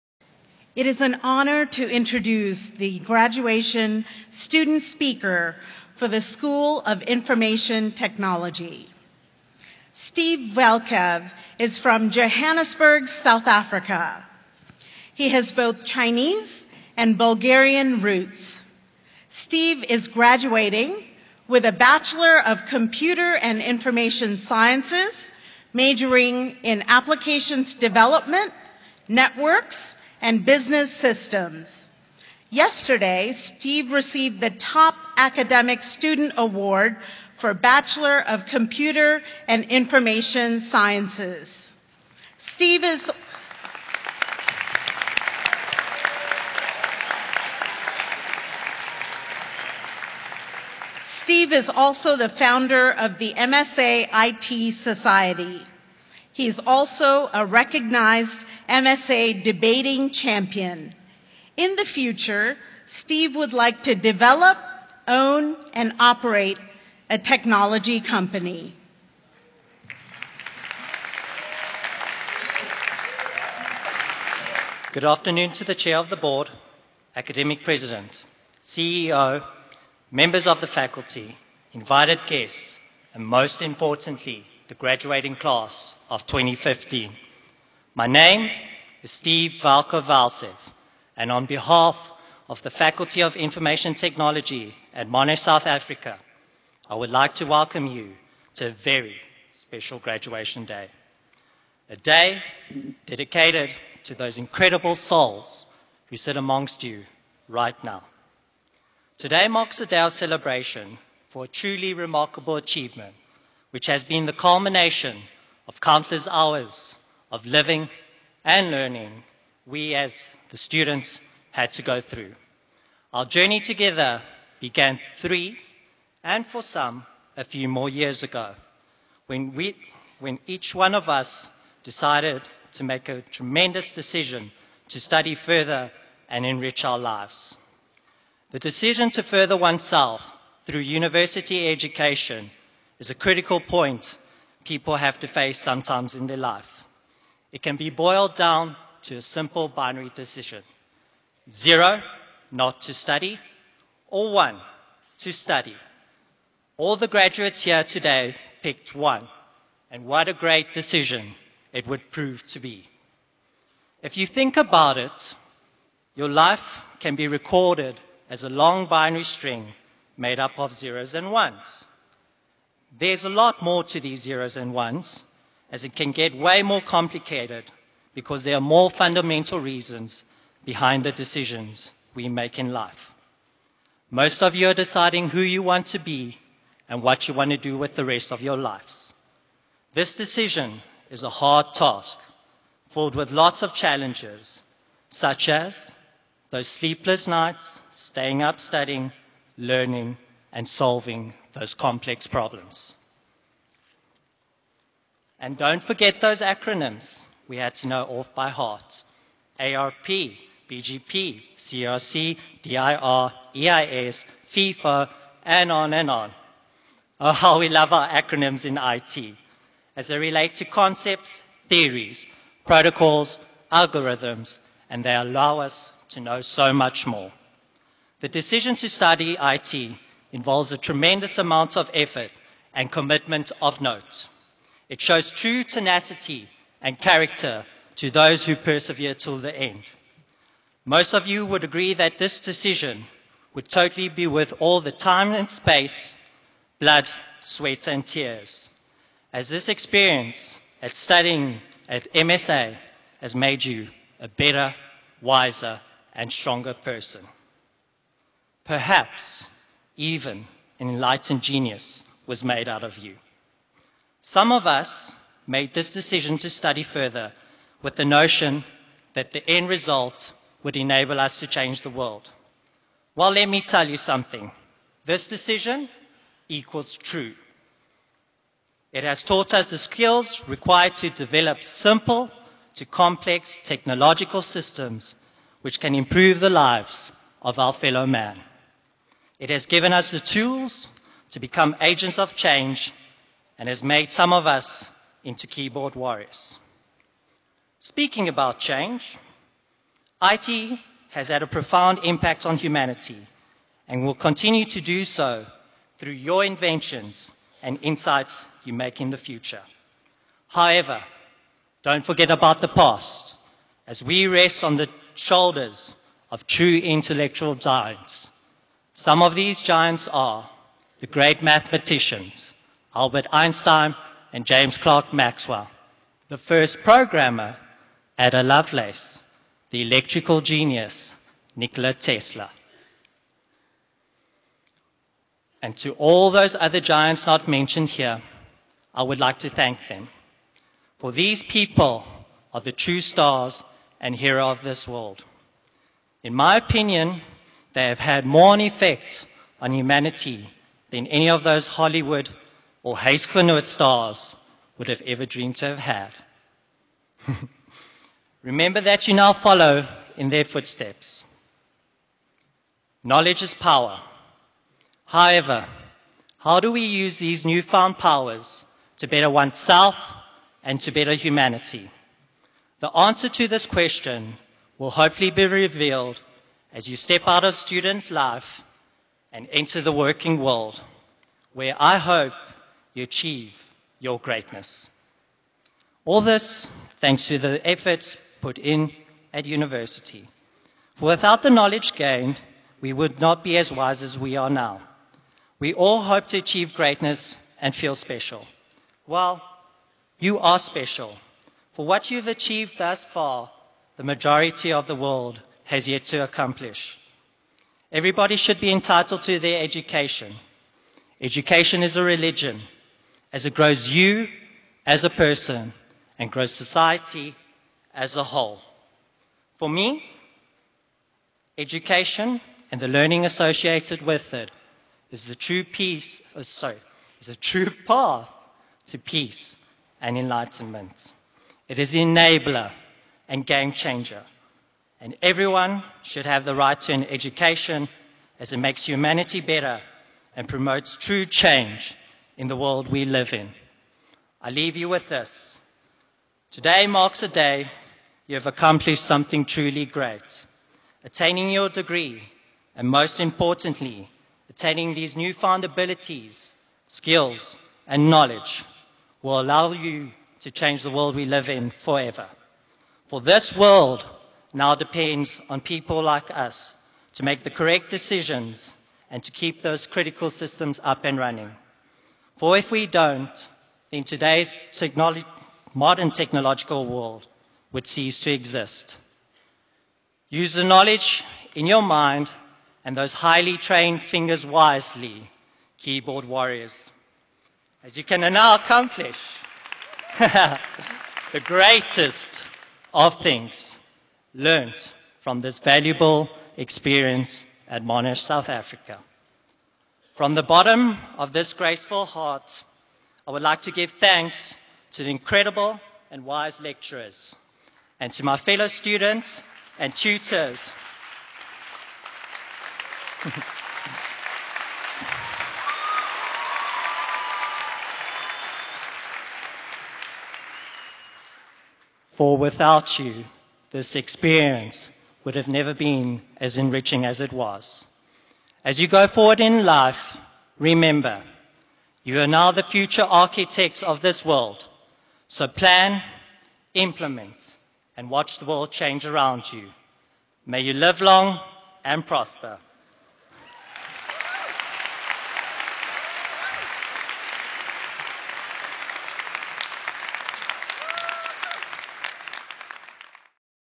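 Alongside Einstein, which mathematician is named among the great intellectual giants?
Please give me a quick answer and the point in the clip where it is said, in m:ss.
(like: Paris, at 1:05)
James Clerk Maxwell, at 5:24.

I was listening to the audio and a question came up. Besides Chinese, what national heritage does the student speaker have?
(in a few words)
Bulgarian.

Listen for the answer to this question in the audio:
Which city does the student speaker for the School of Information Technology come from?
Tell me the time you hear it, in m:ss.
0:12.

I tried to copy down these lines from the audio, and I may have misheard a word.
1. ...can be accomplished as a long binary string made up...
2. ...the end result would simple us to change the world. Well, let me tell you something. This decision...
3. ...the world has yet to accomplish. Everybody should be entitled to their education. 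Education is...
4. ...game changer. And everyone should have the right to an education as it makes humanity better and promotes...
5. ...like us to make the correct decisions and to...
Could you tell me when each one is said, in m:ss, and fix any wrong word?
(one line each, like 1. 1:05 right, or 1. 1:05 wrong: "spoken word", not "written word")
1. 2:47 wrong: "recorded", not "accomplished"
2. 4:29 wrong: "enable", not "simple"
3. 6:44 right
4. 7:13 right
5. 7:46 right.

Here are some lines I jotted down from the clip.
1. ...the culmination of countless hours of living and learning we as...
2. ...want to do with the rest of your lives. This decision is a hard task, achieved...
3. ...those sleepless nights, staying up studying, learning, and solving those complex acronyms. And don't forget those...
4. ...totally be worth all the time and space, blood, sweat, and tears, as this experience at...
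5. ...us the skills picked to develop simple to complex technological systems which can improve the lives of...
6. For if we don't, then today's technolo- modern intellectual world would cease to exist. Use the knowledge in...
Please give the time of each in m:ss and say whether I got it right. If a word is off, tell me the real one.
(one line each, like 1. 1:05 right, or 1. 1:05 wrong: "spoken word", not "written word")
1. 1:54 right
2. 3:07 wrong: "filled", not "achieved"
3. 3:16 wrong: "problems", not "acronyms"
4. 4:03 right
5. 4:39 wrong: "required", not "picked"
6. 7:52 wrong: "technological", not "intellectual".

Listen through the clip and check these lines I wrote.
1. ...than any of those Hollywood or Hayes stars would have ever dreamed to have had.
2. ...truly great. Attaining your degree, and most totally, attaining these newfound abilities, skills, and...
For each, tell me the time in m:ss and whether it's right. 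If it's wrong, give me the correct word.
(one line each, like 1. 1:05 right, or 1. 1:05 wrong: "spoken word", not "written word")
1. 5:50 right
2. 7:29 wrong: "importantly", not "totally".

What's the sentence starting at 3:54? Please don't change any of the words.
It shows true tenacity and character to those who persevere till the end.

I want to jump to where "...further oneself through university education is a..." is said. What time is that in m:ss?
2:19.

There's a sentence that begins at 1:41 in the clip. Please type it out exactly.
A day dedicated to those incredible souls who sit amongst you right now.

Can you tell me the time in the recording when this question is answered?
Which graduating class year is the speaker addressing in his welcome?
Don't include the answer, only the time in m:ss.
1:26.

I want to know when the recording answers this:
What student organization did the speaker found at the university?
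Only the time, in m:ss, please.
0:53.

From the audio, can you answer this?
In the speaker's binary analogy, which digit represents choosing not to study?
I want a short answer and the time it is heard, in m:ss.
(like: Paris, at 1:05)
zero, at 2:31.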